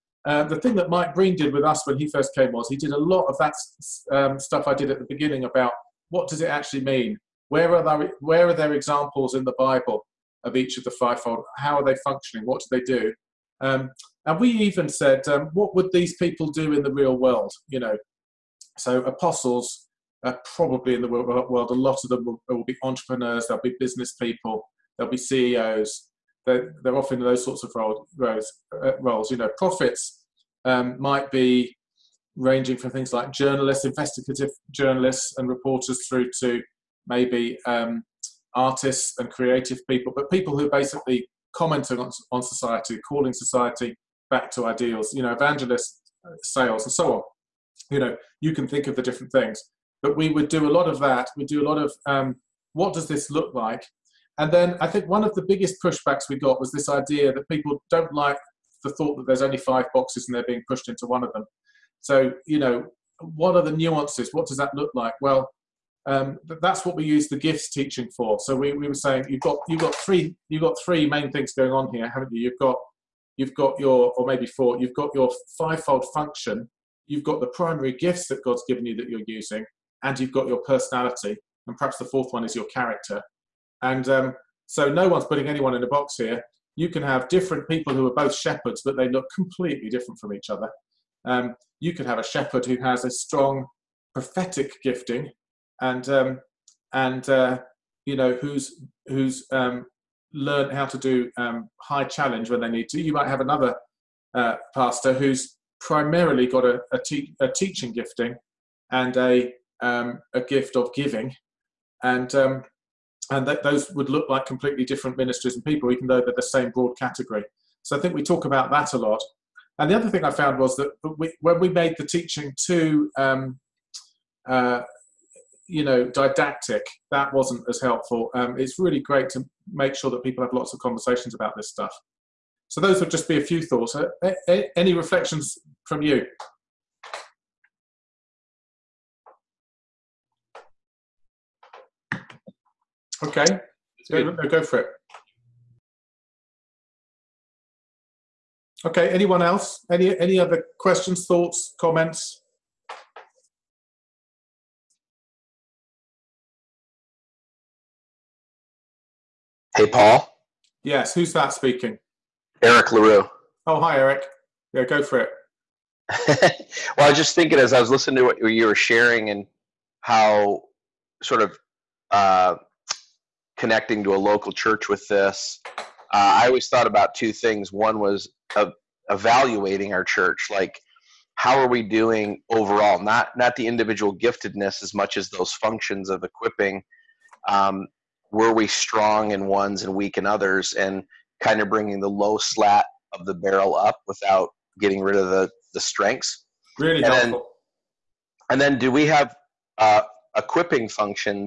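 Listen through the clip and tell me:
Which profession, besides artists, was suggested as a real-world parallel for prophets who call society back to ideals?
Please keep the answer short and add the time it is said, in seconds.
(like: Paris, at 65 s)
Investigative journalists, at 33 s.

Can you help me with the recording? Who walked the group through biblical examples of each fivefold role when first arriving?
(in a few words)
Mike Breen.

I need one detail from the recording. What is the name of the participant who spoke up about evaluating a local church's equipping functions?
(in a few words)
Eric Larue.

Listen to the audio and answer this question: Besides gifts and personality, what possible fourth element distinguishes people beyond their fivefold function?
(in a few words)
Character.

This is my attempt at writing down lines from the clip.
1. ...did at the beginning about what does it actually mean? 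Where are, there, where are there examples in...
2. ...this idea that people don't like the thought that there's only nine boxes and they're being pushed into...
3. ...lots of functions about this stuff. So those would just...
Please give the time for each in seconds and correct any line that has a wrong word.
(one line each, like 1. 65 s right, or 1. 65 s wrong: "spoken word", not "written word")
1. 4 s right
2. 56 s wrong: "five", not "nine"
3. 130 s wrong: "conversations", not "functions".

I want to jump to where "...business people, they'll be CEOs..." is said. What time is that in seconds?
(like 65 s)
23 s.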